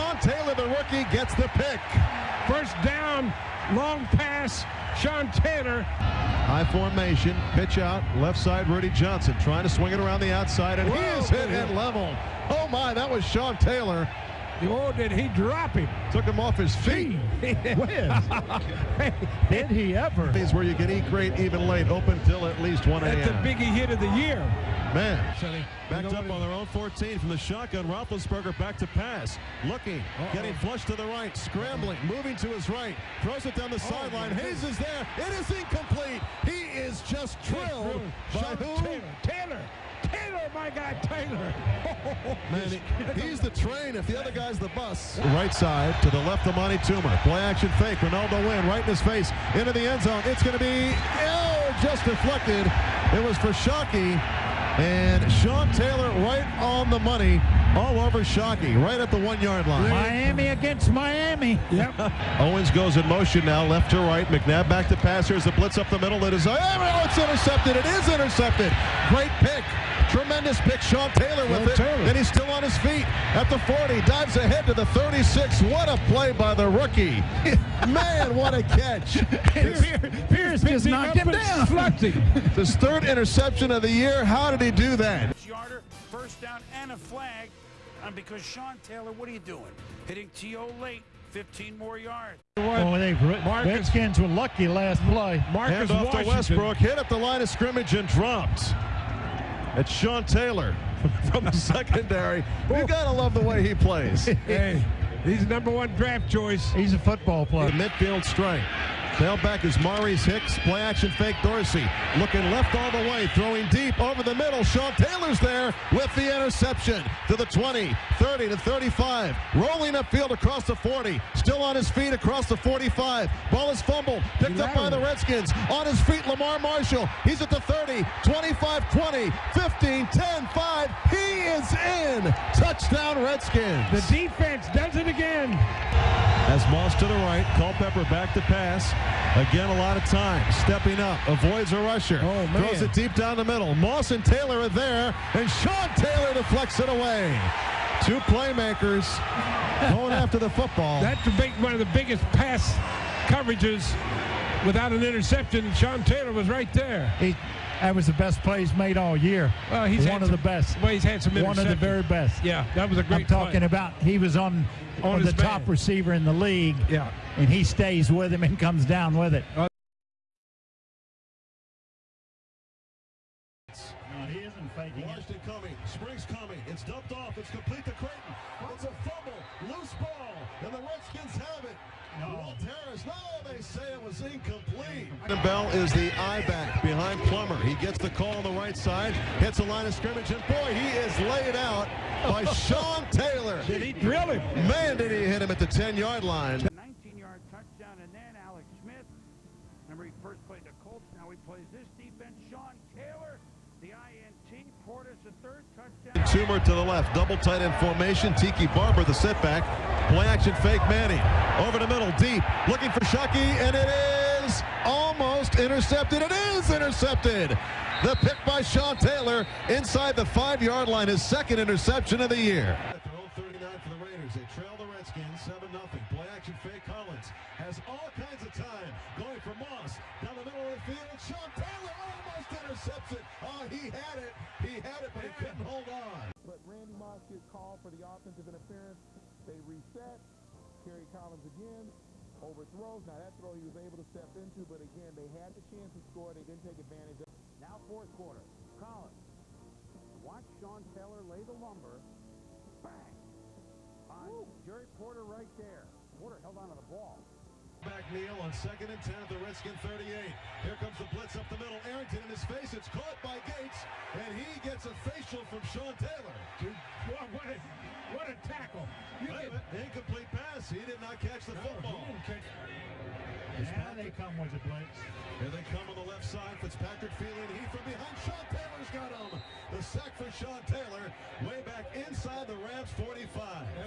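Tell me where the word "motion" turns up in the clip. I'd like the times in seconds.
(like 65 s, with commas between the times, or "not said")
63 s.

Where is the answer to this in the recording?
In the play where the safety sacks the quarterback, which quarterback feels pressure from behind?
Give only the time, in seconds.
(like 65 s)
276 s.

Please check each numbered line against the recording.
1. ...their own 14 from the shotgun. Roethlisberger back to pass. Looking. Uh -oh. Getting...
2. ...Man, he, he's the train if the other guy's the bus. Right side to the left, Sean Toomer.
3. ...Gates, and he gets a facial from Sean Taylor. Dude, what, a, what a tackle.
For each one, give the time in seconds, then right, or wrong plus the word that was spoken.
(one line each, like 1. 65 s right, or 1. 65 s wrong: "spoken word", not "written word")
1. 26 s right
2. 42 s wrong: "Amani", not "Sean"
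3. 263 s right.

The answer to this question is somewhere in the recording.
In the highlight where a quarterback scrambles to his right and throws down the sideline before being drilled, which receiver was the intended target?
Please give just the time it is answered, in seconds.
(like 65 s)
34 s.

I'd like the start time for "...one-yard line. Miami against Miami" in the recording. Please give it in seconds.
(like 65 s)
59 s.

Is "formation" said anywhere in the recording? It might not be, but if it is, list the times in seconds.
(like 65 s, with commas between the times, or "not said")
6 s, 207 s.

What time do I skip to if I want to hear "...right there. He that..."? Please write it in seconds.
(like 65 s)
156 s.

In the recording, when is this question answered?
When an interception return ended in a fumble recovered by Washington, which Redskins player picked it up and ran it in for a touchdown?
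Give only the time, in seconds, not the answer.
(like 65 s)
126 s.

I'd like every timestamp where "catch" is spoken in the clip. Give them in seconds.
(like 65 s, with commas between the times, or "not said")
78 s, 271 s.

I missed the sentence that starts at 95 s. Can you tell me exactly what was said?
Marcus off to Westbrook, hit up the line of scrimmage and dropped.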